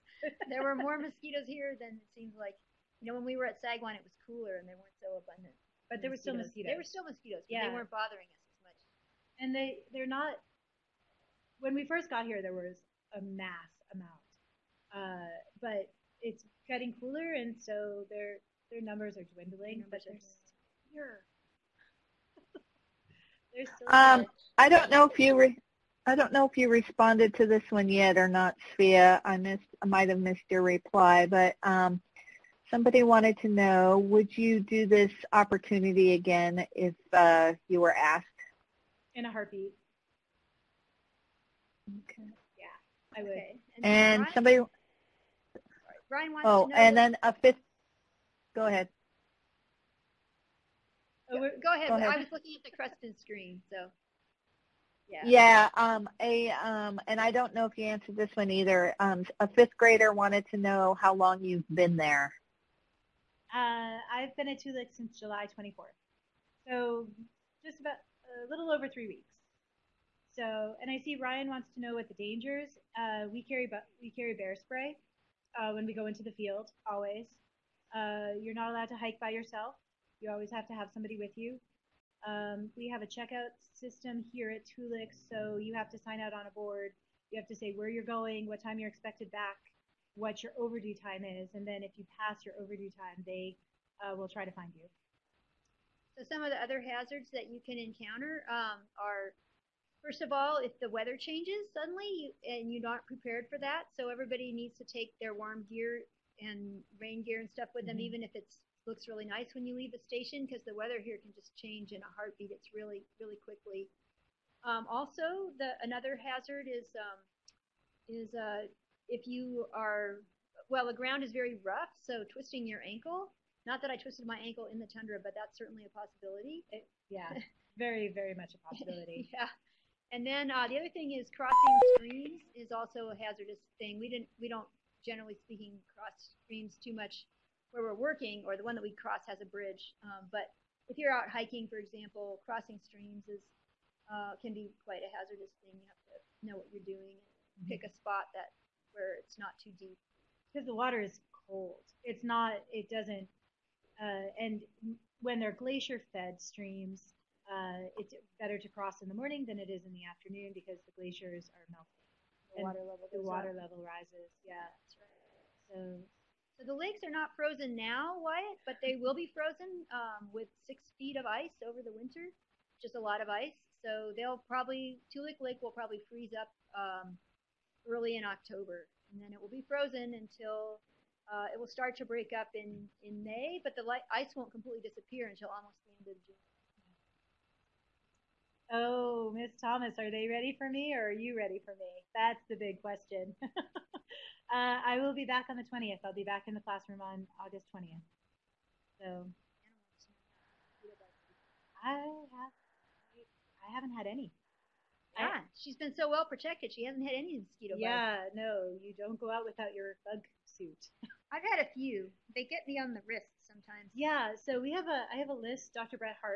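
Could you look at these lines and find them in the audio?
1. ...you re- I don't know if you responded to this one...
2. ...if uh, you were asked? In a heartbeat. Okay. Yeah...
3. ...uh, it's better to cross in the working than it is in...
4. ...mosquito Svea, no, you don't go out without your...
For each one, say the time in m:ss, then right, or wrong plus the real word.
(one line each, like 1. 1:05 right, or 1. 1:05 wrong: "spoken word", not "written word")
1. 0:25 right
2. 0:36 right
3. 2:37 wrong: "morning", not "working"
4. 3:27 wrong: "Yeah", not "Svea".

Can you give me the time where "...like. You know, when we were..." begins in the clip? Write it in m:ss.
0:02.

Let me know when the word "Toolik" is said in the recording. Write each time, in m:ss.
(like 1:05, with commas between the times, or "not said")
1:04, 2:55.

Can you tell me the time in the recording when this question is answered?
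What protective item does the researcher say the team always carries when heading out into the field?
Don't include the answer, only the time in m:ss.
1:14.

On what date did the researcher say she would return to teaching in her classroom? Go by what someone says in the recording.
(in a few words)
August 20.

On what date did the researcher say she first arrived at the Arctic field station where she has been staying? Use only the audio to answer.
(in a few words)
July 24.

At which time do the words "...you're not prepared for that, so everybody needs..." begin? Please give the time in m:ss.
1:42.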